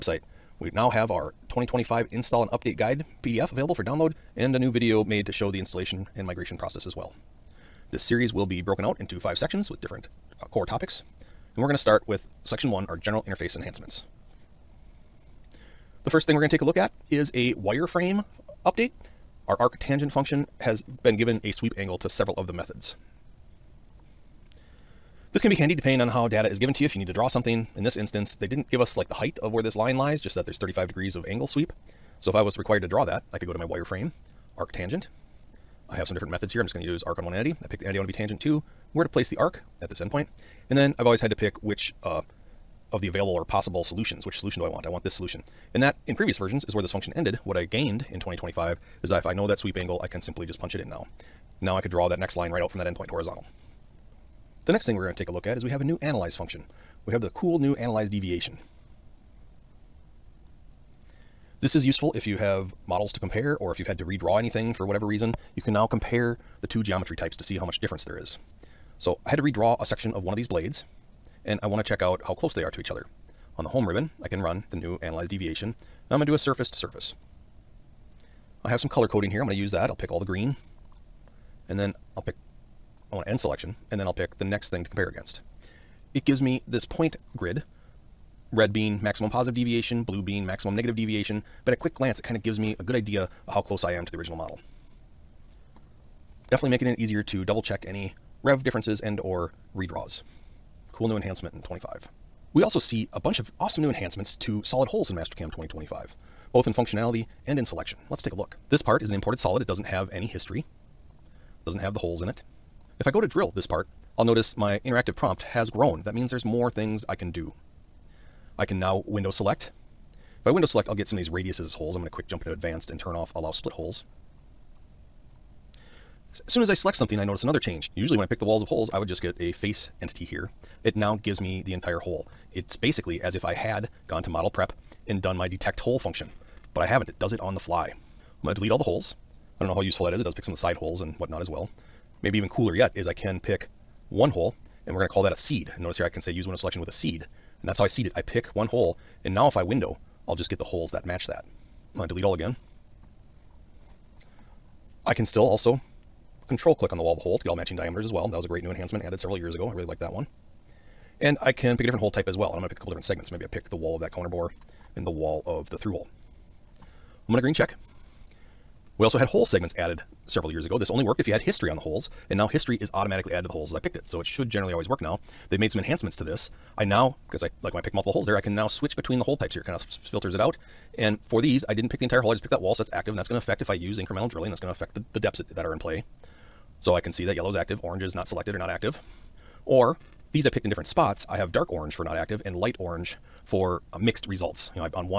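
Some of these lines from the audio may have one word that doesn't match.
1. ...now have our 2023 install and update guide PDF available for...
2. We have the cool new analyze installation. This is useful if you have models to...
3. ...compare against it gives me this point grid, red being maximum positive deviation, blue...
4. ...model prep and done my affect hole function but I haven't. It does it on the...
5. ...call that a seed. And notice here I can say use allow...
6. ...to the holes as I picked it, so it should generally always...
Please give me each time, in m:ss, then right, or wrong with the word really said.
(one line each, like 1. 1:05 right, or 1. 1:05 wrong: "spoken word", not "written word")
1. 0:00 wrong: "2025", not "2023"
2. 0:57 wrong: "deviation", not "installation"
3. 1:24 right
4. 2:14 wrong: "detect", not "affect"
5. 2:25 wrong: "window", not "allow"
6. 2:53 right.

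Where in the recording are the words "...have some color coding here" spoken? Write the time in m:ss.
1:18.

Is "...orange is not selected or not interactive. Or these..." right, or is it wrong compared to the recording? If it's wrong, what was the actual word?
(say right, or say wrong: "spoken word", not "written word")
wrong: "active", not "interactive".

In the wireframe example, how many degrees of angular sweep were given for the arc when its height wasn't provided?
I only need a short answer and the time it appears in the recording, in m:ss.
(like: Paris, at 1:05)
35, at 0:30.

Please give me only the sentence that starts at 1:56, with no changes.
That means there's more things I can do.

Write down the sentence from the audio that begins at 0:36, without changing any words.
I'm just going to use arc on one entity.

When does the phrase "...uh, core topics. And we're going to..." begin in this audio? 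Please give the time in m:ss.
0:10.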